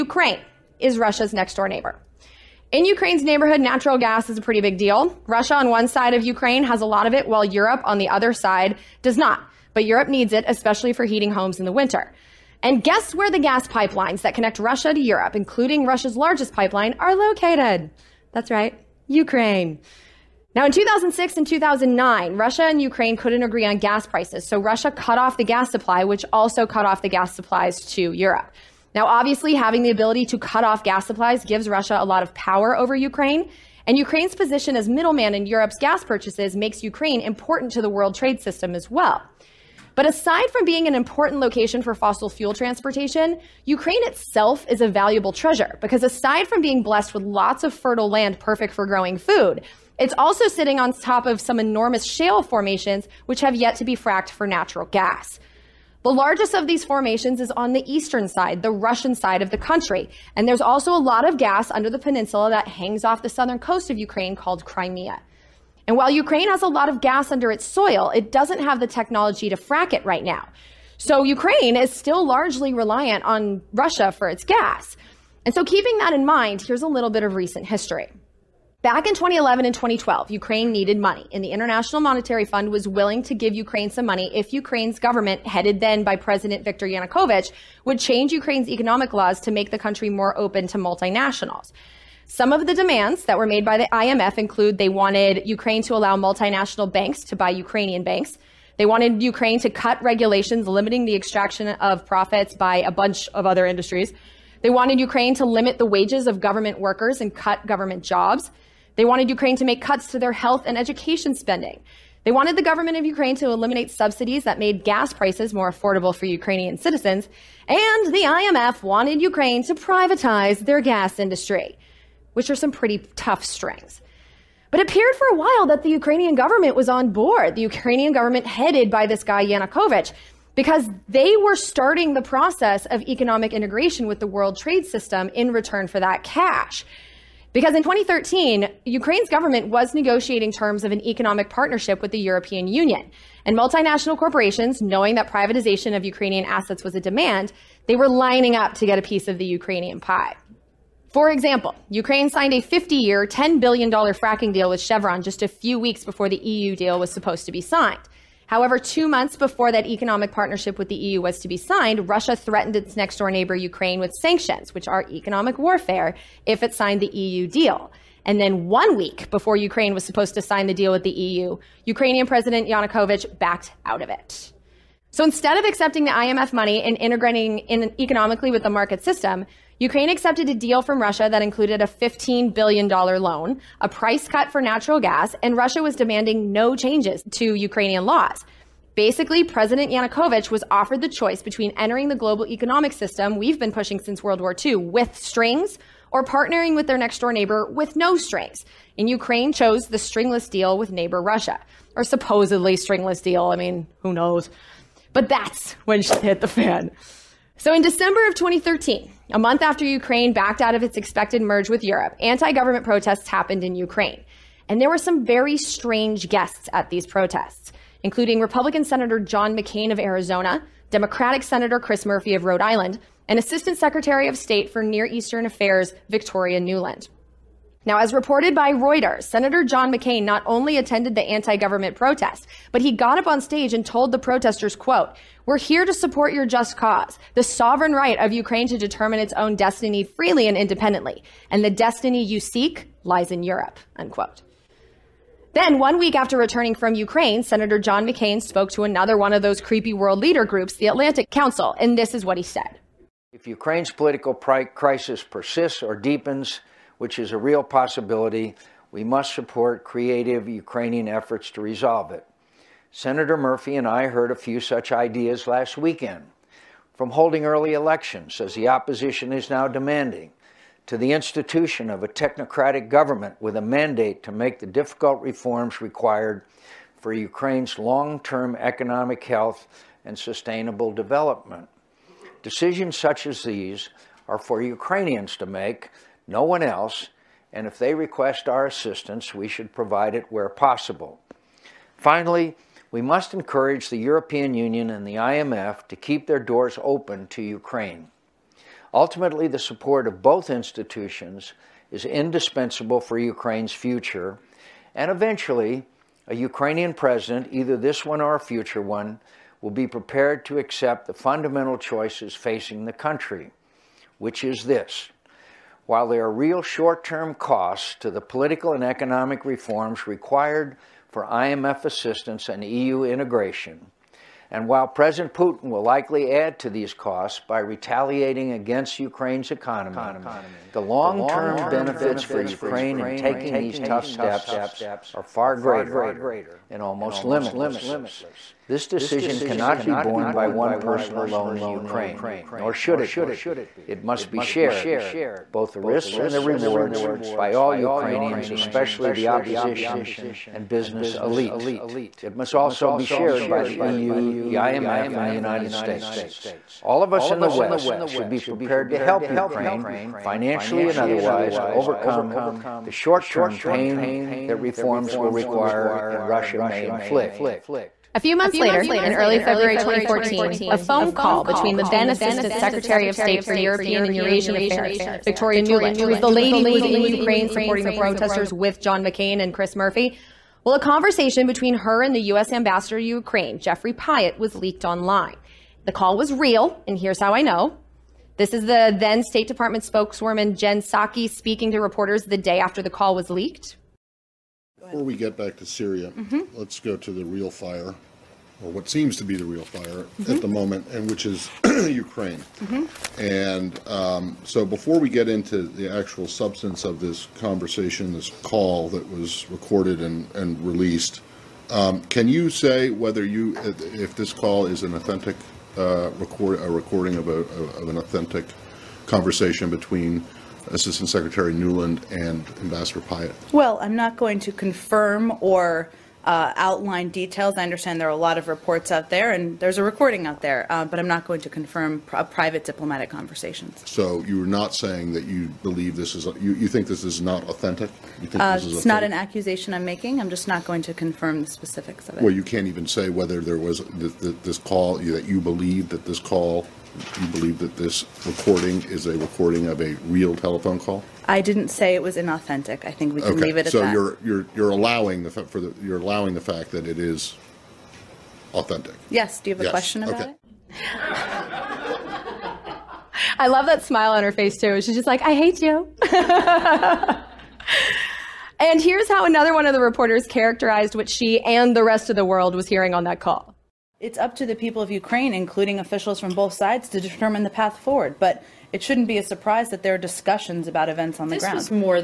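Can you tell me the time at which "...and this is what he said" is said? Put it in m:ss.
4:11.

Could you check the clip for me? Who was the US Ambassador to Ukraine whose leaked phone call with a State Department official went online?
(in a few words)
Jeffrey Pyatt.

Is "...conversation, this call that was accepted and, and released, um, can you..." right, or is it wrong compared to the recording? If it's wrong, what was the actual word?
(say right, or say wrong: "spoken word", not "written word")
wrong: "recorded", not "accepted".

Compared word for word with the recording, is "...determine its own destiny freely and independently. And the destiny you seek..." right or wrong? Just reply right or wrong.
right.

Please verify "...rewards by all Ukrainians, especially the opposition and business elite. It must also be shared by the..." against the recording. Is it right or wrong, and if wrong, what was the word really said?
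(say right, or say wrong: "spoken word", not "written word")
right.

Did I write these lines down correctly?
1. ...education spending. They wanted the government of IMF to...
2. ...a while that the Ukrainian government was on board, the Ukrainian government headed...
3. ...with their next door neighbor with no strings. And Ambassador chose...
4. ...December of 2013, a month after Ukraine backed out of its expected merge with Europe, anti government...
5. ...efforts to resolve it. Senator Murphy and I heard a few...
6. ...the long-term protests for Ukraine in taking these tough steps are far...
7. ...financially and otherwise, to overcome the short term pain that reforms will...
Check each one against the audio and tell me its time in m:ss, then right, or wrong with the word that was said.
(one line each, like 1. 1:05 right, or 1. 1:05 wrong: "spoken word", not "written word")
1. 1:50 wrong: "Ukraine", not "IMF"
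2. 2:05 right
3. 3:16 wrong: "Ukraine", not "Ambassador"
4. 3:27 right
5. 4:21 right
6. 5:30 wrong: "benefits", not "protests"
7. 6:00 right.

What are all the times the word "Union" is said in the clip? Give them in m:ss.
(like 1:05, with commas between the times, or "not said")
2:22, 4:54.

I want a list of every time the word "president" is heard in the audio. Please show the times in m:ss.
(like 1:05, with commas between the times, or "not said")
1:26, 2:52, 3:09, 5:06, 5:24.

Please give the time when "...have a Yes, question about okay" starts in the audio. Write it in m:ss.
7:39.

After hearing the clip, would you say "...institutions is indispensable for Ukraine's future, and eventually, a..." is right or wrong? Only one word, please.
right.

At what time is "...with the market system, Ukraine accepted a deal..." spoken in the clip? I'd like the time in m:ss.
2:58.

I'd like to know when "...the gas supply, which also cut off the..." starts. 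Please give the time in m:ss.
0:25.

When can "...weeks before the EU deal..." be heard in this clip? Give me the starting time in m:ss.
2:35.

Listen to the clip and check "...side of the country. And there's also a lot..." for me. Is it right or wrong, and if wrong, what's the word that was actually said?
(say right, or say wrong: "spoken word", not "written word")
right.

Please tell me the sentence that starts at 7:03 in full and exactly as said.
Well, I'm not going to confirm or uh, outline details.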